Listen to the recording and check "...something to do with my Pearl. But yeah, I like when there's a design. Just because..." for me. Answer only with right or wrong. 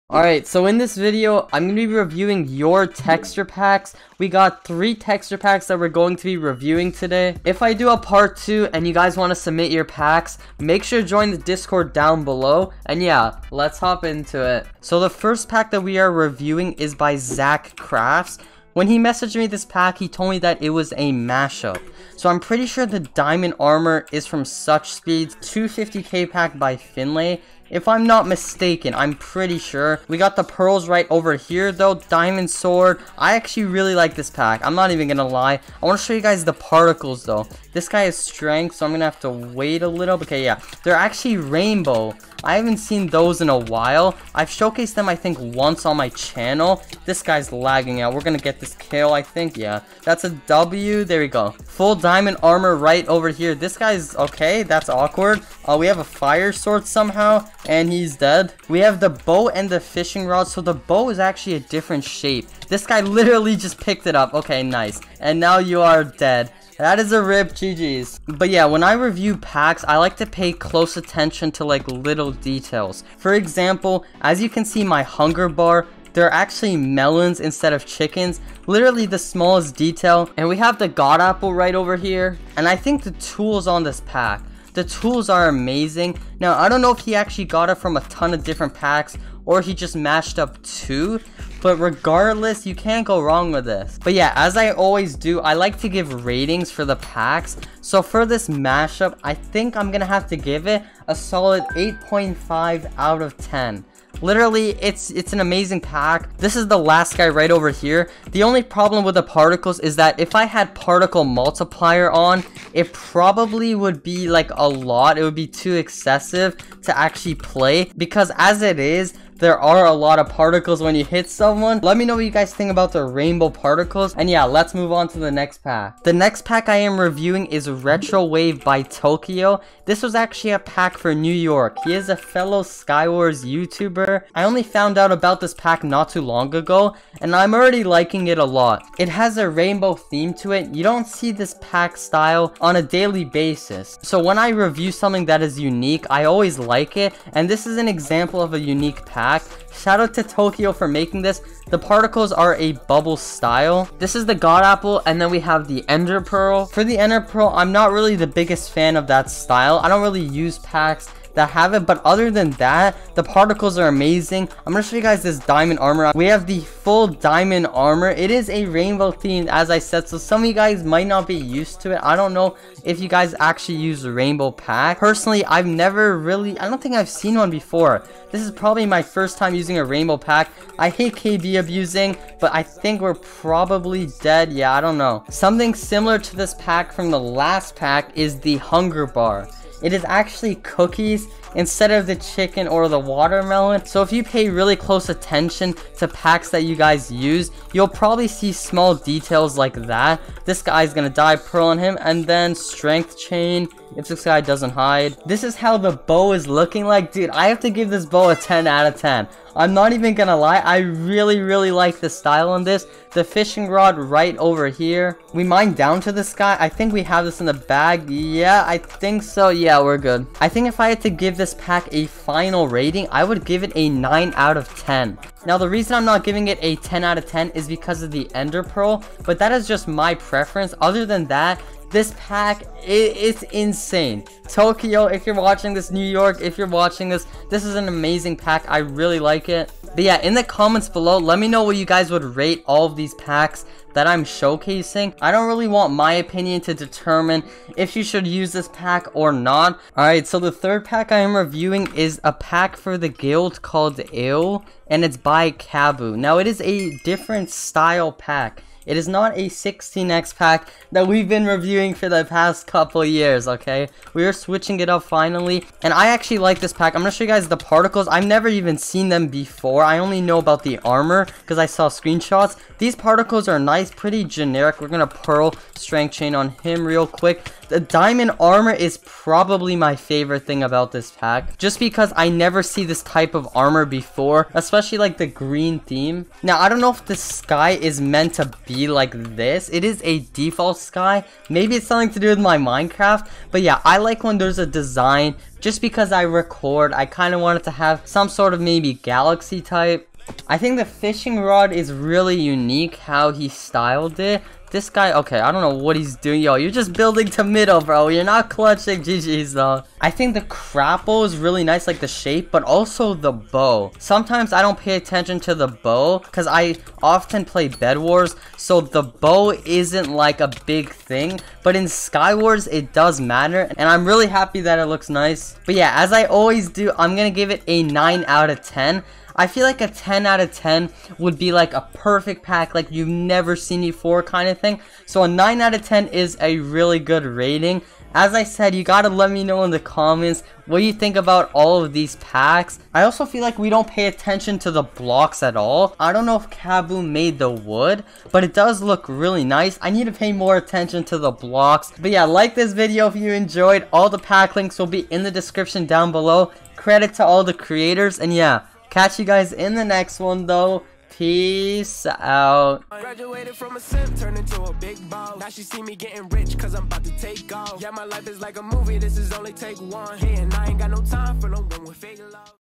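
wrong.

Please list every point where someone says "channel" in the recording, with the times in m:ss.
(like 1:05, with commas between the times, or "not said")
0:46.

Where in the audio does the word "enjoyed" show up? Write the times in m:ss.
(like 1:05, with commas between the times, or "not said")
5:53.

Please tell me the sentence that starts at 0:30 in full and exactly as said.
We got the pearls right over here though.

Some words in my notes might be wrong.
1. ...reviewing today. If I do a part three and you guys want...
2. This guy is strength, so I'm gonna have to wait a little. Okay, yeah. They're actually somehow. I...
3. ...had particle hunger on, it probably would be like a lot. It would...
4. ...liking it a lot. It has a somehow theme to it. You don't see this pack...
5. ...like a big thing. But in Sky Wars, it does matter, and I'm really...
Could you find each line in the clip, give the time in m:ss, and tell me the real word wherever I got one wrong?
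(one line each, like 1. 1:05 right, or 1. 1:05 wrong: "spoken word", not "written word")
1. 0:06 wrong: "two", not "three"
2. 0:37 wrong: "rainbow", not "somehow"
3. 1:50 wrong: "multiplier", not "hunger"
4. 2:17 wrong: "rainbow", not "somehow"
5. 5:20 right.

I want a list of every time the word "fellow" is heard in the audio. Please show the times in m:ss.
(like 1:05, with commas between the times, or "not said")
2:12.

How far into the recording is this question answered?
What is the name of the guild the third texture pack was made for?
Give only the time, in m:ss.
4:14.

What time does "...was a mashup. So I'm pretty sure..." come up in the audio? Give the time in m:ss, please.
0:20.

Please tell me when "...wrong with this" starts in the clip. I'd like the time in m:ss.
1:33.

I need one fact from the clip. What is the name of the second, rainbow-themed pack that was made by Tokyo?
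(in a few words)
Retro Wave.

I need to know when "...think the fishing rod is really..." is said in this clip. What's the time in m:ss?
5:00.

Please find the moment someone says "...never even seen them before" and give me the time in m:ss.
4:28.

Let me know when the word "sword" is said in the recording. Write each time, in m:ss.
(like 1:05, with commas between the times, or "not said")
0:32, 0:56.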